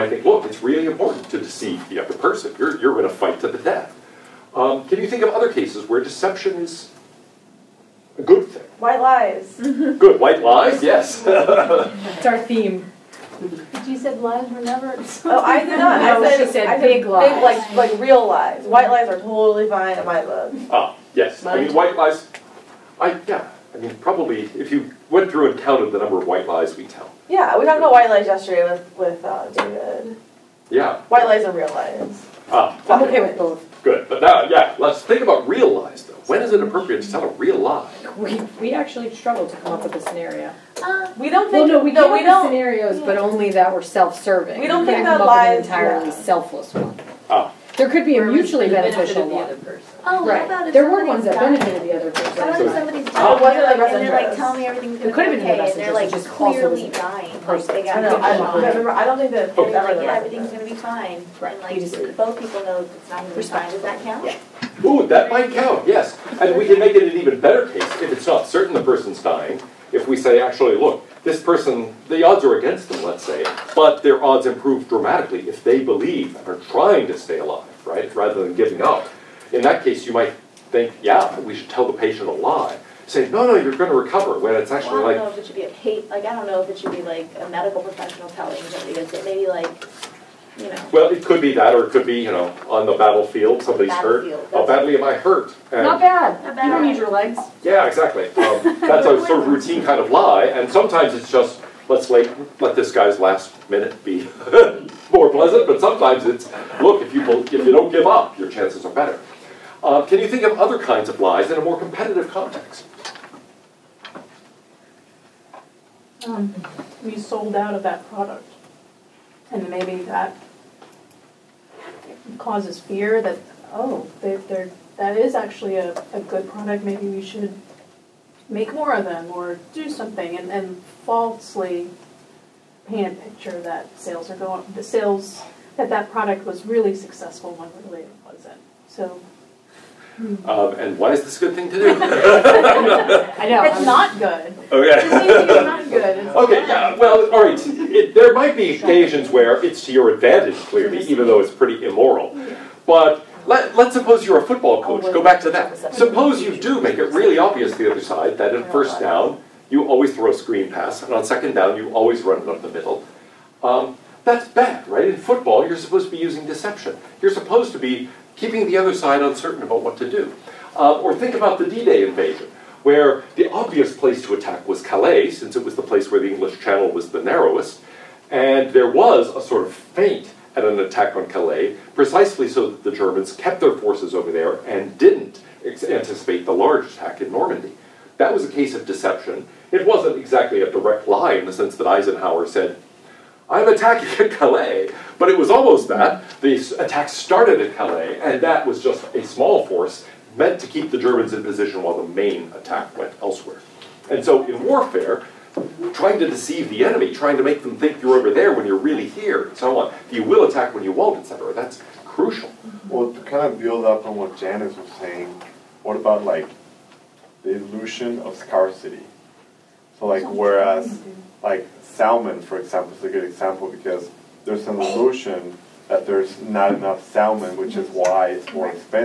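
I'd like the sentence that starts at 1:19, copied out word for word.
In that case, you might think, yeah, we should tell the patient a lie.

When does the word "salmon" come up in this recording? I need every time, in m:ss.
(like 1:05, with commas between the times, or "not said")
3:41, 3:47.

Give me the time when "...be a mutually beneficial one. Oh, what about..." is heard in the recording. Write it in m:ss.
0:48.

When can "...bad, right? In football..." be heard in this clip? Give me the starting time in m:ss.
2:44.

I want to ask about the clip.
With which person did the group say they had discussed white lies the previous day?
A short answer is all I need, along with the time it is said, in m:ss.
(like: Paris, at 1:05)
David, at 0:29.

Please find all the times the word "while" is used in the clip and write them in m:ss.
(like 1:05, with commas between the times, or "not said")
3:21.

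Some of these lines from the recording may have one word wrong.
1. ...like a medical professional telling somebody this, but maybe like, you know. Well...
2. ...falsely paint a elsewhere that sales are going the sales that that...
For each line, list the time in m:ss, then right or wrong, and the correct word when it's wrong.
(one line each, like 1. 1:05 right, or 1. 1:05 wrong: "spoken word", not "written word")
1. 1:27 right
2. 2:11 wrong: "picture", not "elsewhere".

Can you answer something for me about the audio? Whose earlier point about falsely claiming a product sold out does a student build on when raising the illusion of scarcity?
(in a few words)
Janice.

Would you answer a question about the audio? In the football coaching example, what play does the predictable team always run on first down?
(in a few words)
Screen pass.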